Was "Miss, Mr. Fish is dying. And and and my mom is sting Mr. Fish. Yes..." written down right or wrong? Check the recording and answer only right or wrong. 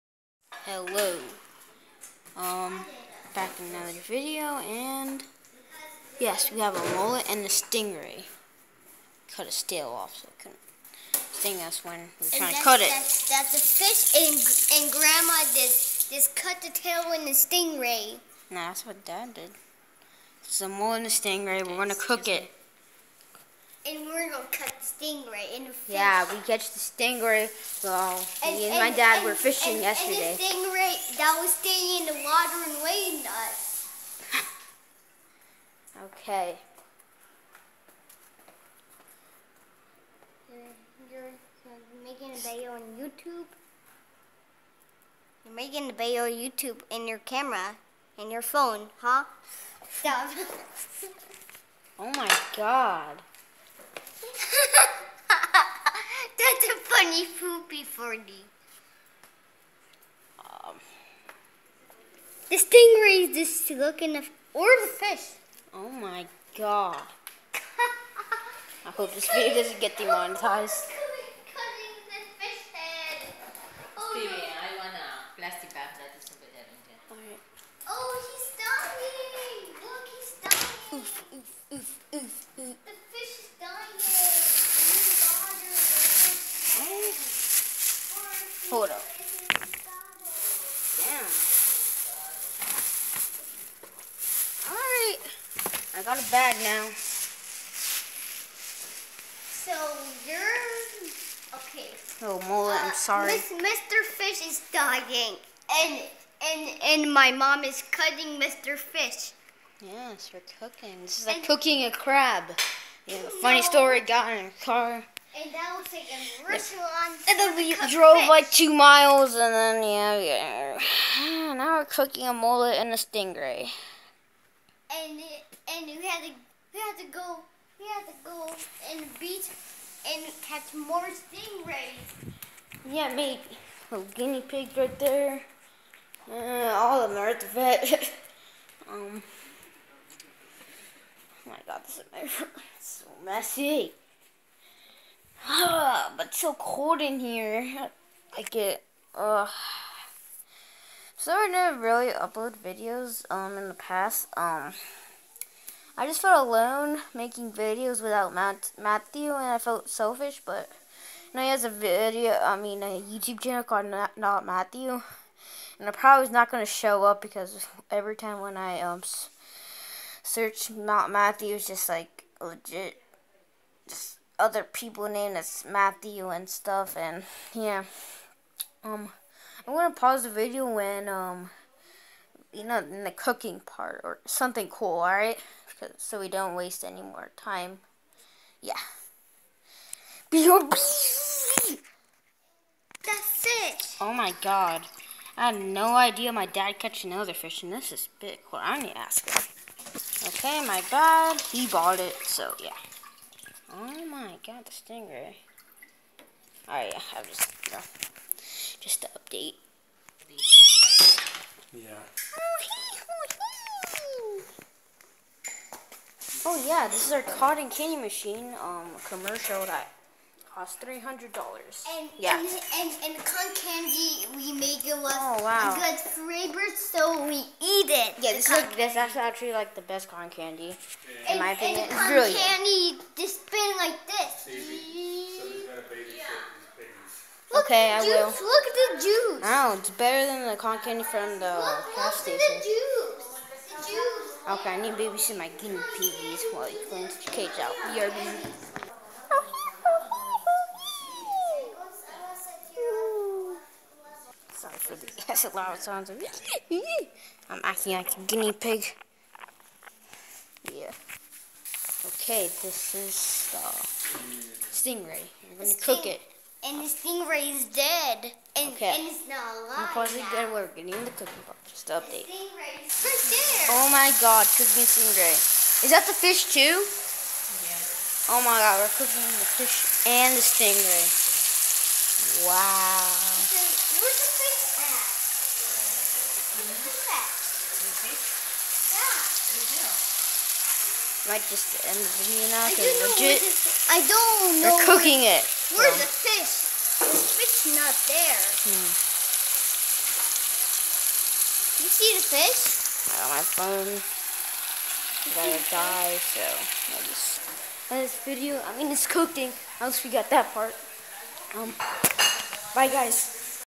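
wrong.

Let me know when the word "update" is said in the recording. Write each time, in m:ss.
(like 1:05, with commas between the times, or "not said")
3:29, 4:31.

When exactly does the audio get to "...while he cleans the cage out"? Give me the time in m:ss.
4:06.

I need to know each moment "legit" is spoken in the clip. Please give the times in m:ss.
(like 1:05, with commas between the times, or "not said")
2:52, 4:53.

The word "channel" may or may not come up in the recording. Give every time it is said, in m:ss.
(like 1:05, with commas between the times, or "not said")
2:43.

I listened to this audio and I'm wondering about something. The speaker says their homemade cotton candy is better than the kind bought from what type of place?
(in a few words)
Gas station.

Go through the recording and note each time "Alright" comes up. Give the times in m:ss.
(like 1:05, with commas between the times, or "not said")
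1:34, 3:26.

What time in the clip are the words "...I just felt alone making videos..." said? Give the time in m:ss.
2:35.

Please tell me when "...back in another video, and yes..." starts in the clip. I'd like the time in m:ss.
0:03.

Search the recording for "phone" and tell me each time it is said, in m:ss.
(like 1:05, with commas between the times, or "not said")
0:48, 5:03.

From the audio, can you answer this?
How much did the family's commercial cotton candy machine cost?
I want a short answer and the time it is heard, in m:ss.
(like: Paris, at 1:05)
$300, at 3:40.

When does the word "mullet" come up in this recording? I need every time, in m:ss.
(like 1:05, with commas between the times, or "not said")
0:06, 0:20, 2:02.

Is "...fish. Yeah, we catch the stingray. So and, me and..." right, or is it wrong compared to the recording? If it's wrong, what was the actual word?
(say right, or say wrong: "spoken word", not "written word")
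right.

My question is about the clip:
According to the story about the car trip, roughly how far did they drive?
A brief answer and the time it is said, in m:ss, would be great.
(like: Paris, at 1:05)
2 miles, at 1:58.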